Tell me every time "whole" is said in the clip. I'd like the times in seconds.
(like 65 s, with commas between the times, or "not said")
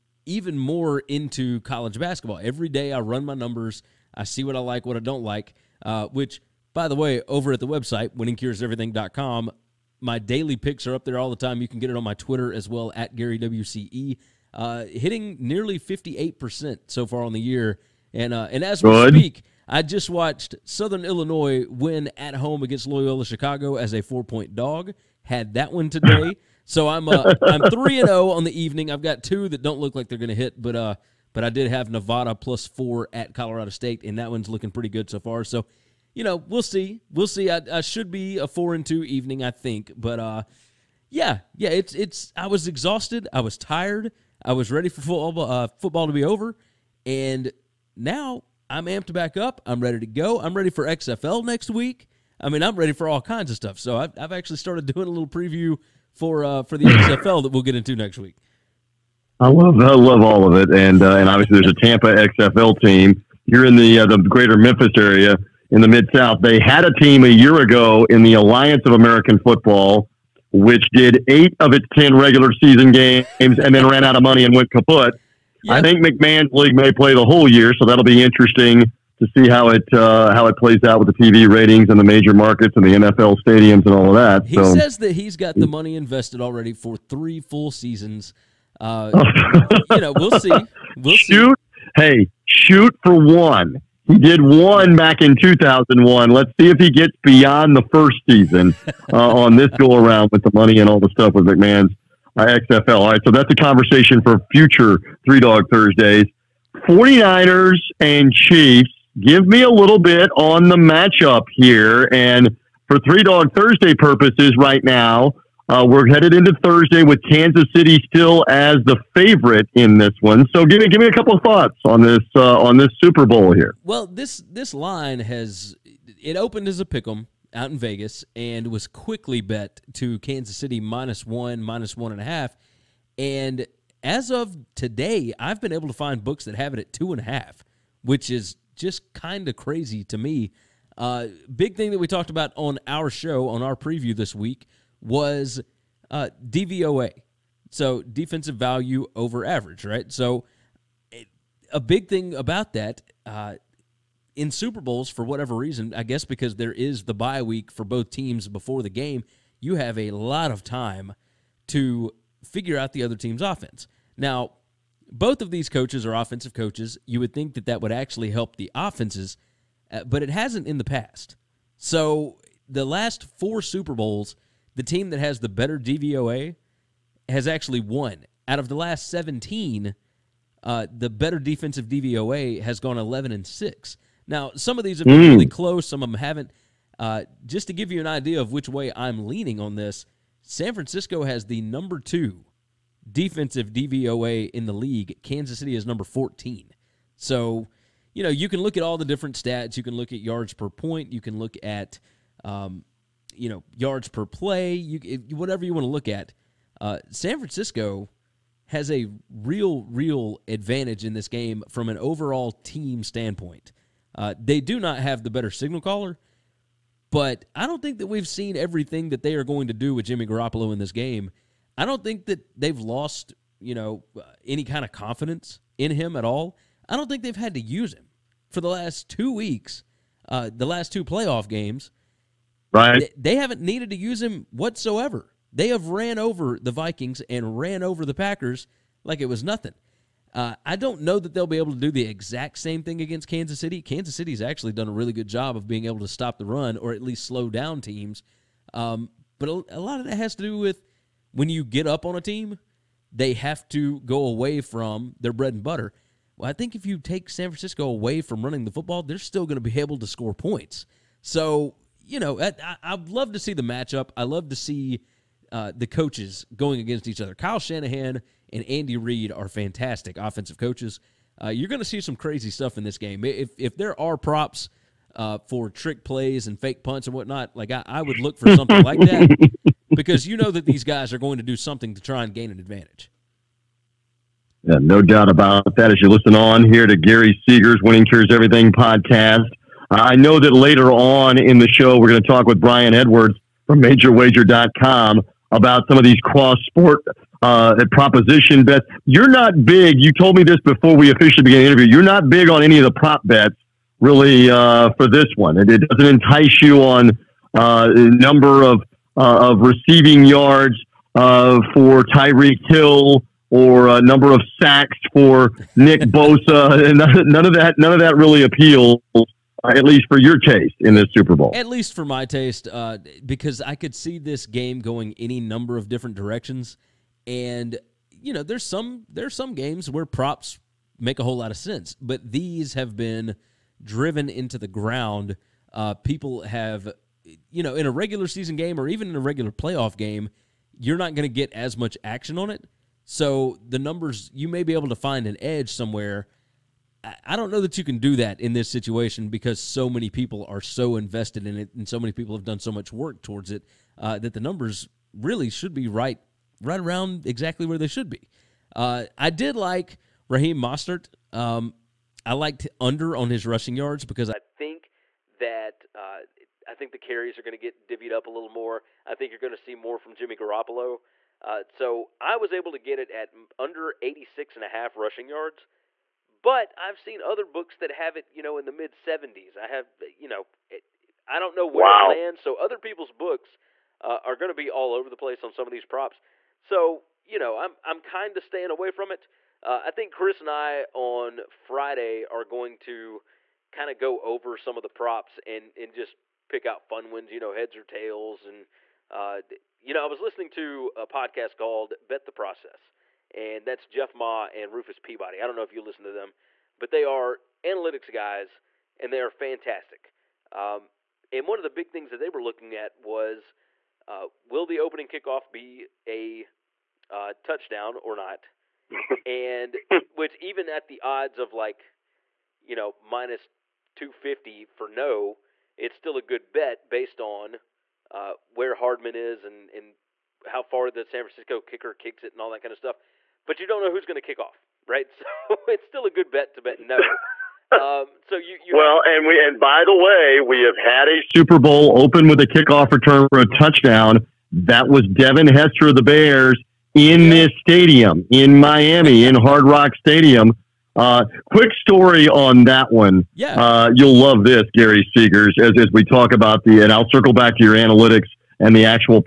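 77 s, 331 s.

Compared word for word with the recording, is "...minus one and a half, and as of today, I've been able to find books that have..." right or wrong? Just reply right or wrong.
right.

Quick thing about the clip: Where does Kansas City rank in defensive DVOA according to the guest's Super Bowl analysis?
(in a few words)
14.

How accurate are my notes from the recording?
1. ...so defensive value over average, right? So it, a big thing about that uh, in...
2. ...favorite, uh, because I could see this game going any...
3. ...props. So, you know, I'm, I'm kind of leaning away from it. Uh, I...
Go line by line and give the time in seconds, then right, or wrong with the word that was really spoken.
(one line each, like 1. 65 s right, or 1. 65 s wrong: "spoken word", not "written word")
1. 147 s right
2. 322 s wrong: "taste", not "favorite"
3. 385 s wrong: "staying", not "leaning".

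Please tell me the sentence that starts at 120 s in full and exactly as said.
So give me give me a couple of thoughts on this uh, on this Super Bowl here.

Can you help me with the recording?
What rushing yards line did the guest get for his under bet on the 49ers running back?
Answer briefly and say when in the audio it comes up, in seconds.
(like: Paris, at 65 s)
86.5, at 374 s.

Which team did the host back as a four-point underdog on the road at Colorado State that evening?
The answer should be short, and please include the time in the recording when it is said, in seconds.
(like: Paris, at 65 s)
Nevada, at 31 s.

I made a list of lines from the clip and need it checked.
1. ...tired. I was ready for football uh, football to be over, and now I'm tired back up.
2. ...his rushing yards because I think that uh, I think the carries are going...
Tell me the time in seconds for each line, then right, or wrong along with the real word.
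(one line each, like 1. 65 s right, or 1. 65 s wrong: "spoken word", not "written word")
1. 43 s wrong: "amped", not "tired"
2. 363 s right.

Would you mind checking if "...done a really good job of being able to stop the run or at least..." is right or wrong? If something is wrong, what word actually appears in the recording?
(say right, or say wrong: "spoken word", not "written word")
right.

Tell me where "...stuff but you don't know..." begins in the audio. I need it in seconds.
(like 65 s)
432 s.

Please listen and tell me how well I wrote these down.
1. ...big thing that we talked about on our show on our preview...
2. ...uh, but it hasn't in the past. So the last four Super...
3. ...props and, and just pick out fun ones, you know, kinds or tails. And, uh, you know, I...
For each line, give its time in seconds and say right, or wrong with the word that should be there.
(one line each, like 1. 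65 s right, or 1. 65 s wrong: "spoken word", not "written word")
1. 141 s right
2. 169 s right
3. 394 s wrong: "heads", not "kinds".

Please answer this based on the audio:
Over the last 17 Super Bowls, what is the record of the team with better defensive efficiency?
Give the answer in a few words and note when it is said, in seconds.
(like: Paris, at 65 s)
11 and 6, at 182 s.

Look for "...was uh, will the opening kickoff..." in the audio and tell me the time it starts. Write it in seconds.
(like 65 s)
412 s.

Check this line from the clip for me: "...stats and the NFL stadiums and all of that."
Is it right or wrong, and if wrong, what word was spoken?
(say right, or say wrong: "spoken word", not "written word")
wrong: "markets", not "stats".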